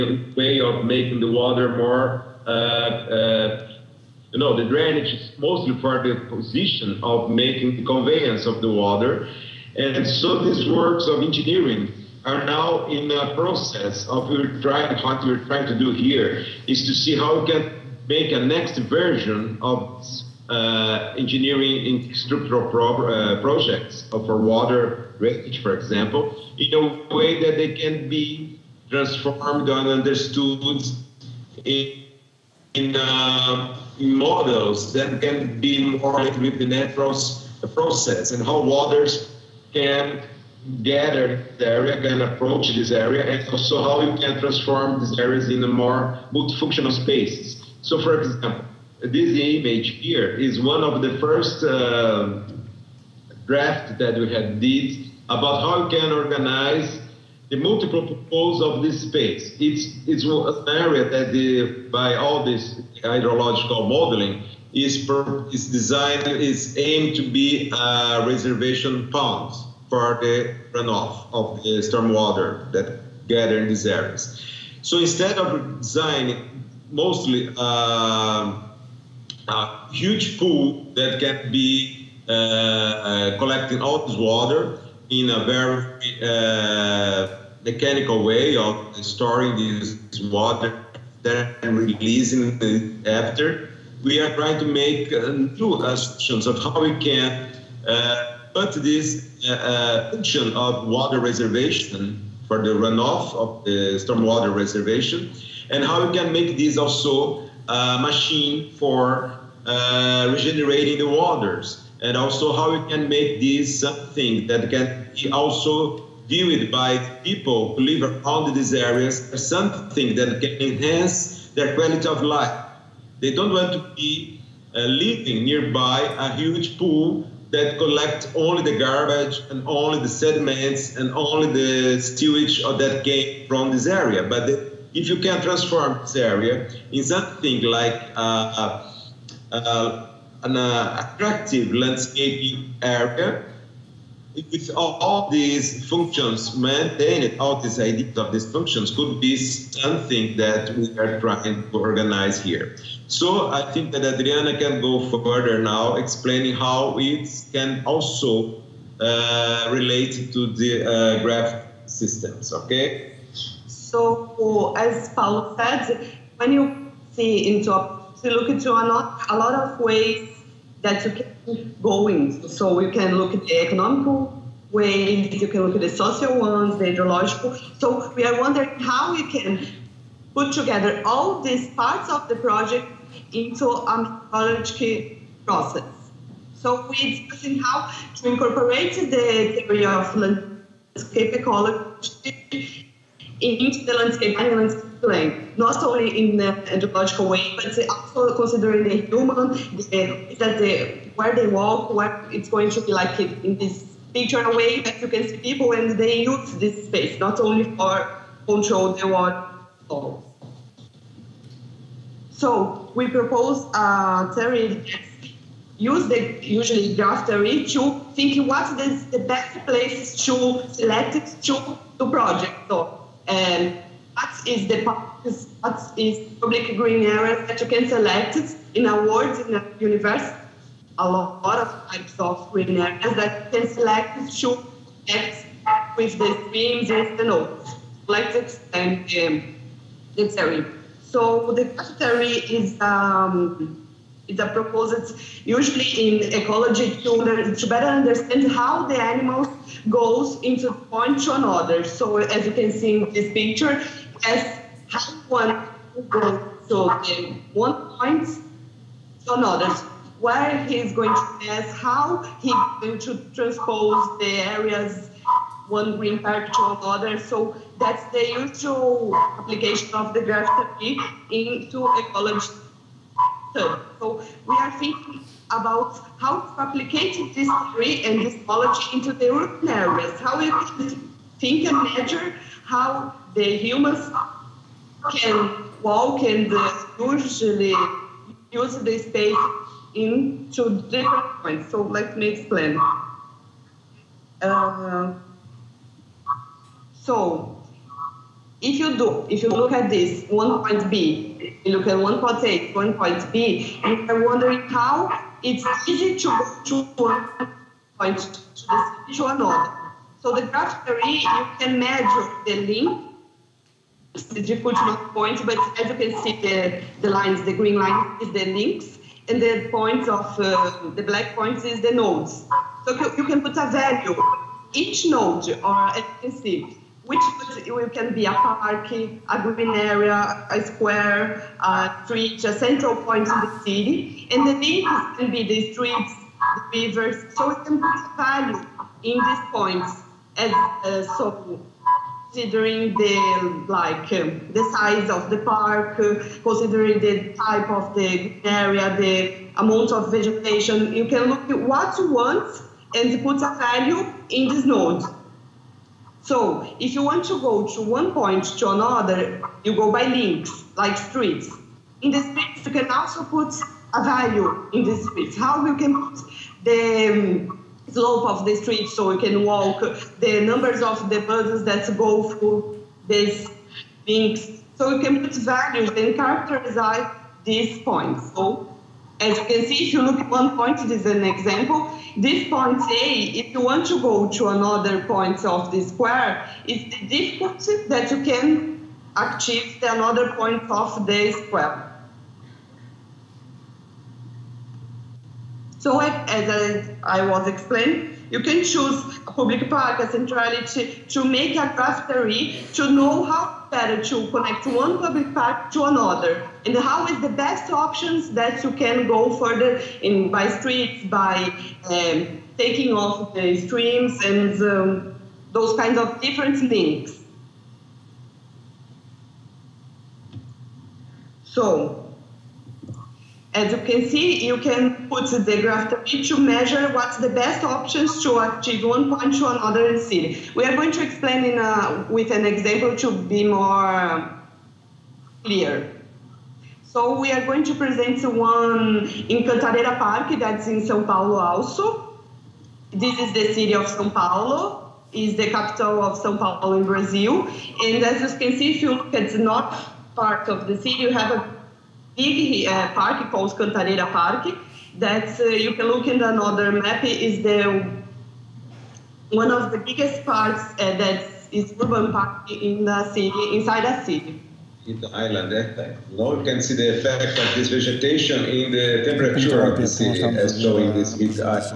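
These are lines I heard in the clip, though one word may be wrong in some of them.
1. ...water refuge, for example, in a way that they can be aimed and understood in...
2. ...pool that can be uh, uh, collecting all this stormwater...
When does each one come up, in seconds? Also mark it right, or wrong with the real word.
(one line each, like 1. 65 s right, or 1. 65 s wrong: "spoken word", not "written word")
1. 24 s wrong: "transformed", not "aimed"
2. 80 s wrong: "water", not "stormwater".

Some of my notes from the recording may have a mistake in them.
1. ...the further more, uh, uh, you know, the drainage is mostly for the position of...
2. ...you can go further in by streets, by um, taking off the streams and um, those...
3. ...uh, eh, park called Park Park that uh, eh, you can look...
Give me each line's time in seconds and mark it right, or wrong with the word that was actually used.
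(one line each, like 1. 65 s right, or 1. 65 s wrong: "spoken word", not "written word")
1. 1 s wrong: "water", not "further"
2. 408 s right
3. 452 s wrong: "Cantareira", not "Park".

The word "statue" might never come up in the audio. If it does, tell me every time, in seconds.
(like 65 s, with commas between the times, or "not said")
not said.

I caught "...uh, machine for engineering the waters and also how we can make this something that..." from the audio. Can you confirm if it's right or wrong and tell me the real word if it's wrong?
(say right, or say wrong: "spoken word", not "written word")
wrong: "regenerating", not "engineering".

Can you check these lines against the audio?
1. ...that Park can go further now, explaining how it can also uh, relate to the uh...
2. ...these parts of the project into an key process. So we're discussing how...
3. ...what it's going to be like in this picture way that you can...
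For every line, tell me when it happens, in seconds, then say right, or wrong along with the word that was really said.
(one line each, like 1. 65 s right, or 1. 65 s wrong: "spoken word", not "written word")
1. 153 s wrong: "Adriana", not "Park"
2. 181 s right
3. 201 s right.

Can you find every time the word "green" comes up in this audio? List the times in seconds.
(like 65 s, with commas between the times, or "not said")
226 s, 232 s, 265 s, 317 s, 329 s.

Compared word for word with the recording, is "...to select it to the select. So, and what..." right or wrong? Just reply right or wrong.
wrong.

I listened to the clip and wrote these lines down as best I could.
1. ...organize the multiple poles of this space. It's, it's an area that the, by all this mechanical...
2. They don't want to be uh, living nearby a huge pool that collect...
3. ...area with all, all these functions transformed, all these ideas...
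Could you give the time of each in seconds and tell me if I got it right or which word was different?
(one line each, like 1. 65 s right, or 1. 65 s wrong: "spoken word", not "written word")
1. 56 s wrong: "hydrological", not "mechanical"
2. 123 s right
3. 142 s wrong: "maintained", not "transformed".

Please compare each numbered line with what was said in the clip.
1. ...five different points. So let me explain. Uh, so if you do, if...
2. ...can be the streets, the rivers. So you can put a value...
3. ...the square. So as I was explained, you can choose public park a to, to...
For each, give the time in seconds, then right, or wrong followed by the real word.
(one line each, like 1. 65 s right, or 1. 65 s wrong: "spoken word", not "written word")
1. 290 s wrong: "two", not "five"
2. 335 s right
3. 391 s right.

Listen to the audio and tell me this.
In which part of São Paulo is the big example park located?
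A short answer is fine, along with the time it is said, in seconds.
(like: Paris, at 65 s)
North, at 449 s.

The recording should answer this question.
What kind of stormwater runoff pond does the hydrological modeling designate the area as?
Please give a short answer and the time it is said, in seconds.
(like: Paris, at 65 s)
Reservation pond, at 68 s.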